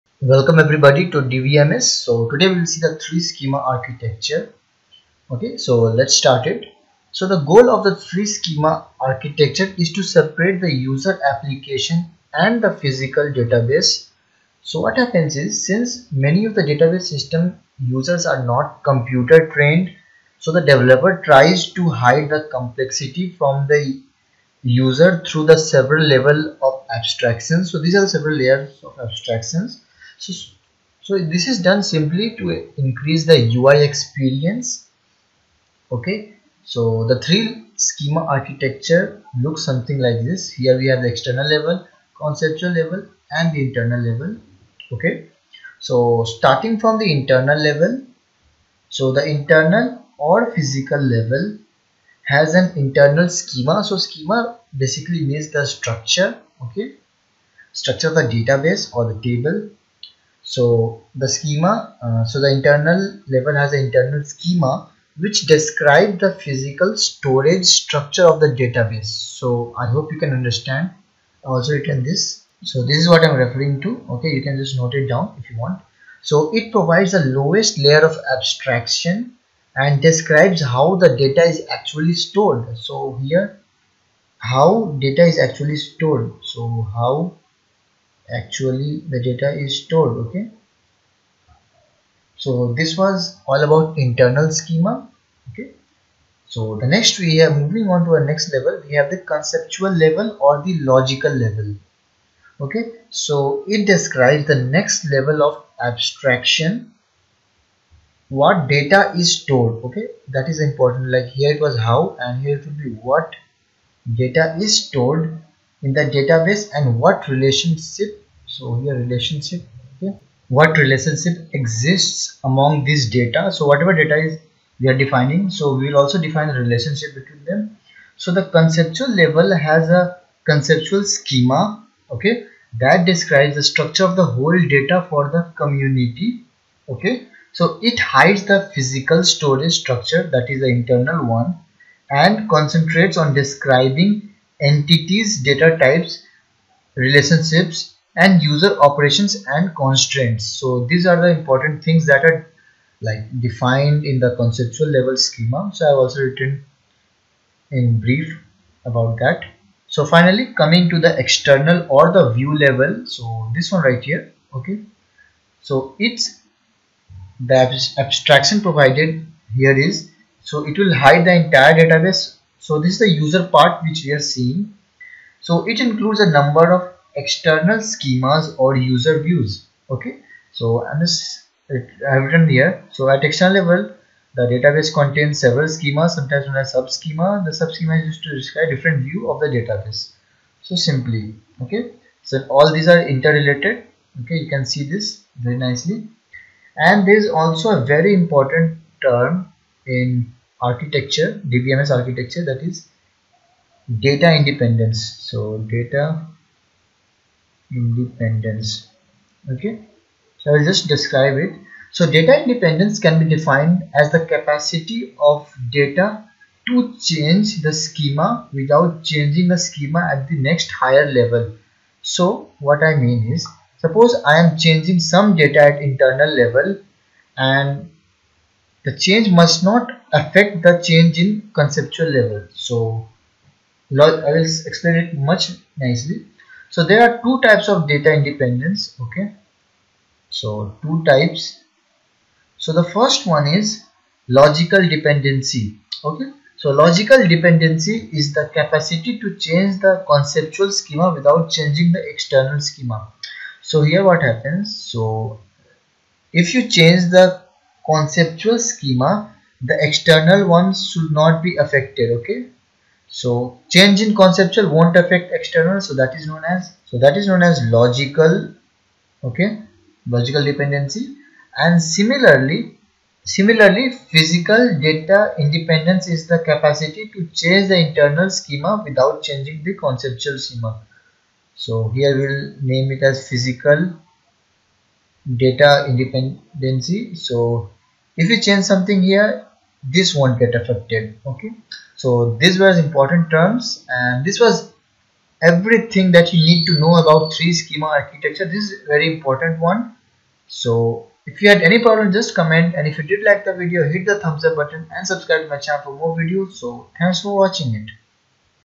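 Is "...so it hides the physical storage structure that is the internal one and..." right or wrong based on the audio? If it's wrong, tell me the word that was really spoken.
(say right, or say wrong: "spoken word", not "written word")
right.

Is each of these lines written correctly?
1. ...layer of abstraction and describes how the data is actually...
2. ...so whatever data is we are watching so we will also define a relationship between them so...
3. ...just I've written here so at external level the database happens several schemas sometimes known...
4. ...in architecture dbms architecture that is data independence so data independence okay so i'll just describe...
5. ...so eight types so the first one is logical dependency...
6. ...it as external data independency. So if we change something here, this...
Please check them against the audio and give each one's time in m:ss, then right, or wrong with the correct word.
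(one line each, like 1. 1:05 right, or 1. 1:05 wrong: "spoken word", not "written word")
1. 1:17 right
2. 2:03 wrong: "defining", not "watching"
3. 3:01 wrong: "contains", not "happens"
4. 3:19 right
5. 4:00 wrong: "two", not "eight"
6. 4:42 wrong: "physical", not "external".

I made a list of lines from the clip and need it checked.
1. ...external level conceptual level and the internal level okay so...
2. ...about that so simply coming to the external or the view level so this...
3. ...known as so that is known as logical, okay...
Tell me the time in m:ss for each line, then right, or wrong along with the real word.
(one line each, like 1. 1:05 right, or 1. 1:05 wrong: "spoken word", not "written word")
1. 0:41 right
2. 2:38 wrong: "finally", not "simply"
3. 4:26 right.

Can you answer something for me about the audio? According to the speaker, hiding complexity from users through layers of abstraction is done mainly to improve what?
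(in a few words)
UI experience.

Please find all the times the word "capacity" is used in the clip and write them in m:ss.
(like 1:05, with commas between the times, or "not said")
3:34, 4:08, 4:36.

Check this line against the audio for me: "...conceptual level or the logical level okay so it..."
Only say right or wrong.
right.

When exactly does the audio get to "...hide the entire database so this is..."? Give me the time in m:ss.
2:50.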